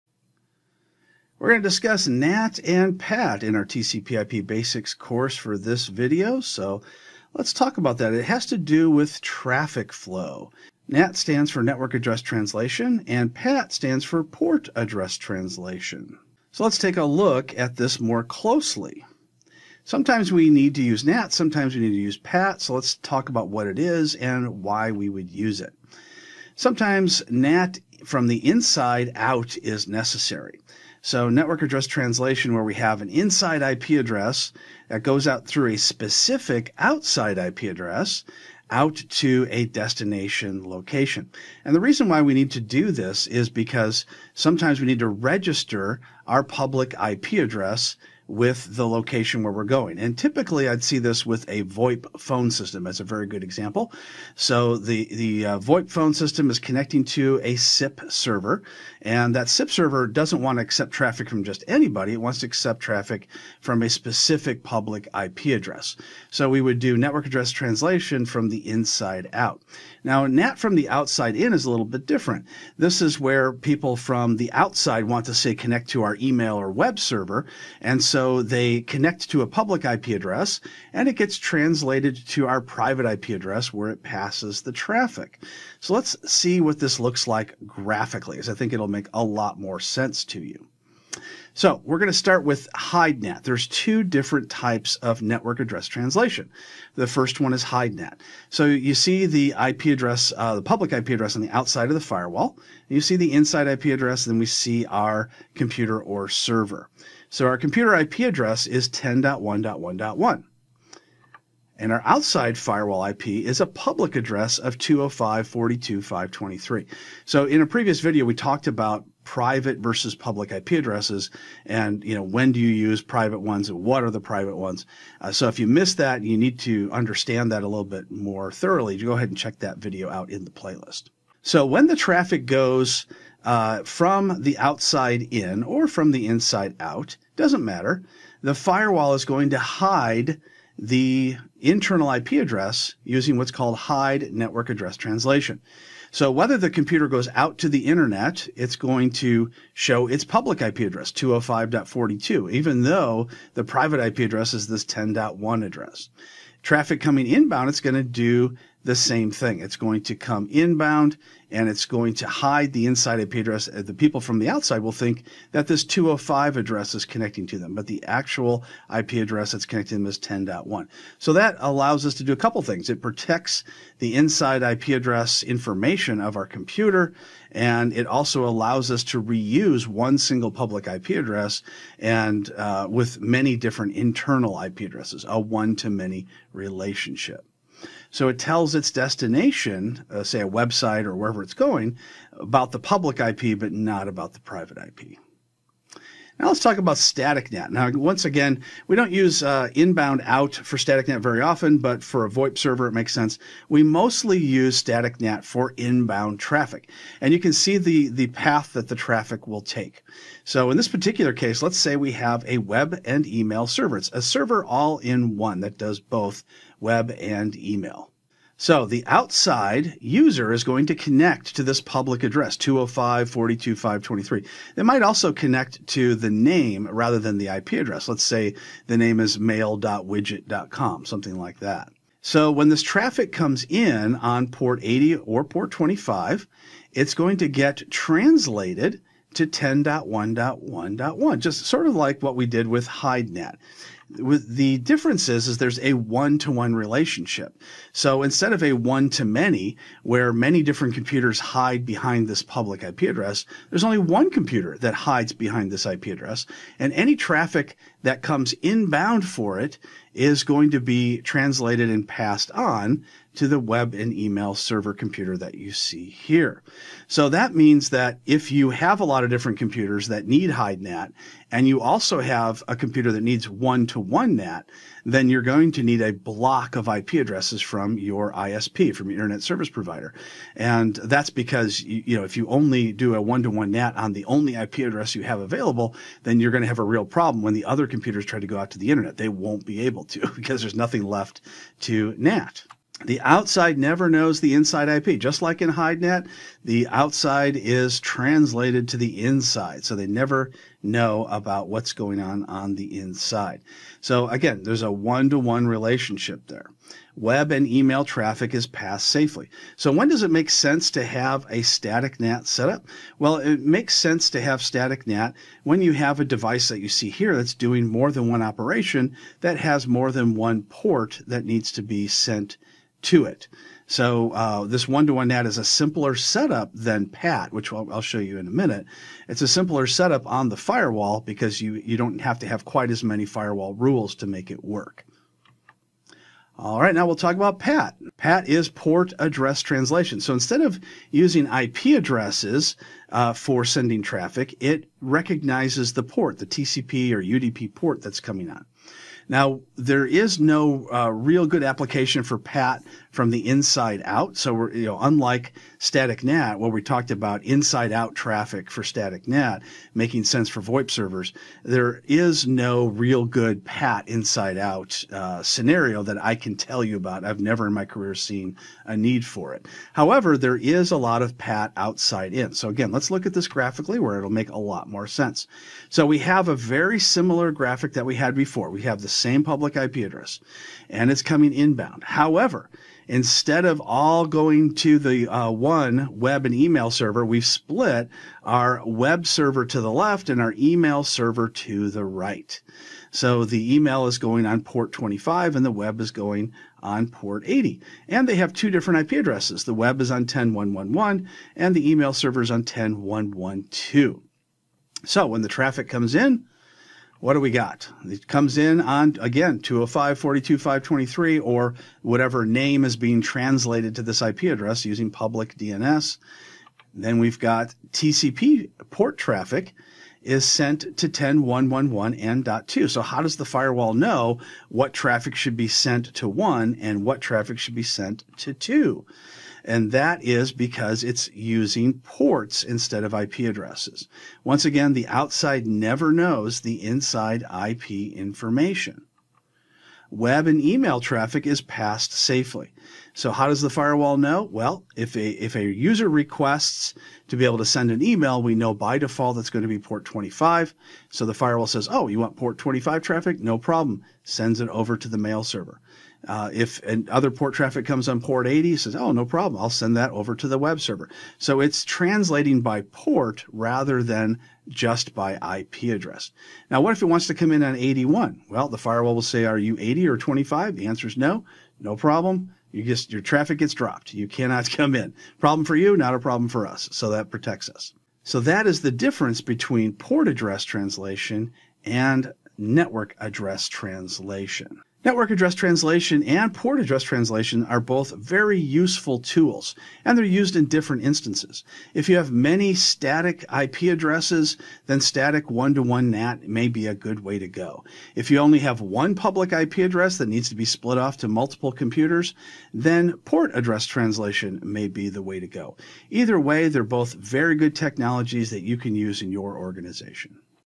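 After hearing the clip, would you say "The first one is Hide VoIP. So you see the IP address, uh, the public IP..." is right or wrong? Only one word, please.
wrong.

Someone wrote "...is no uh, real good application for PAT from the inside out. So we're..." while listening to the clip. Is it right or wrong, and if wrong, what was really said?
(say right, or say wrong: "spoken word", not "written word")
right.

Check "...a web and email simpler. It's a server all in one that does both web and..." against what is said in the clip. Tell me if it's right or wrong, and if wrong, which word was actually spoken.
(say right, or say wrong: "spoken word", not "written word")
wrong: "server", not "simpler".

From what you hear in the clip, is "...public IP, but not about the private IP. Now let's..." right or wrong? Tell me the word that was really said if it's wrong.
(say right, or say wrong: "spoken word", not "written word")
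right.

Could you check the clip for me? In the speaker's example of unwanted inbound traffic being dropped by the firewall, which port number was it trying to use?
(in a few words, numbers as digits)
81.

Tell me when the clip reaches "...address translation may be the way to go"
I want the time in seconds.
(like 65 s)
503 s.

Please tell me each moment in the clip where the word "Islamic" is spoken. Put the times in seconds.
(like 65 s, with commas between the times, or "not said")
not said.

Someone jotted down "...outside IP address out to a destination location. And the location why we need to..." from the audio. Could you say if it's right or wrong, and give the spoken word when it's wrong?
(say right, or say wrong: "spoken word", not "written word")
wrong: "reason", not "location".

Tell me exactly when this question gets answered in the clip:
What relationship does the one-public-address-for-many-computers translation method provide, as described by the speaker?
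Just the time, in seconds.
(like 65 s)
185 s.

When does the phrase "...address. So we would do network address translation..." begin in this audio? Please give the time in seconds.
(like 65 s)
65 s.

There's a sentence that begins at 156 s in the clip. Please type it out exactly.
Traffic coming inbound, it's going to do the same thing.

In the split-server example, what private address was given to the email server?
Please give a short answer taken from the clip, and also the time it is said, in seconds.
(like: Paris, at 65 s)
10.1.1.2, at 402 s.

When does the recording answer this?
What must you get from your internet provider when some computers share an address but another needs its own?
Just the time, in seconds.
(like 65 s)
276 s.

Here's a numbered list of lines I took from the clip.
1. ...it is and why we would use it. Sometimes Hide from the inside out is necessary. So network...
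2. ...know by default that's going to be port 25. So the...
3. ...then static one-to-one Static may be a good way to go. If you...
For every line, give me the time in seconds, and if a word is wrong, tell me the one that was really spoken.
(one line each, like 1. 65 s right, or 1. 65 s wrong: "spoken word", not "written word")
1. 23 s wrong: "NAT", not "Hide"
2. 448 s right
3. 494 s wrong: "NAT", not "Static".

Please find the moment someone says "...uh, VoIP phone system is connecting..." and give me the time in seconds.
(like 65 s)
55 s.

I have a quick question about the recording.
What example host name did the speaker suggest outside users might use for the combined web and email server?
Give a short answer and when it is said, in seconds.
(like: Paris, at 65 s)
mail.widget.com, at 229 s.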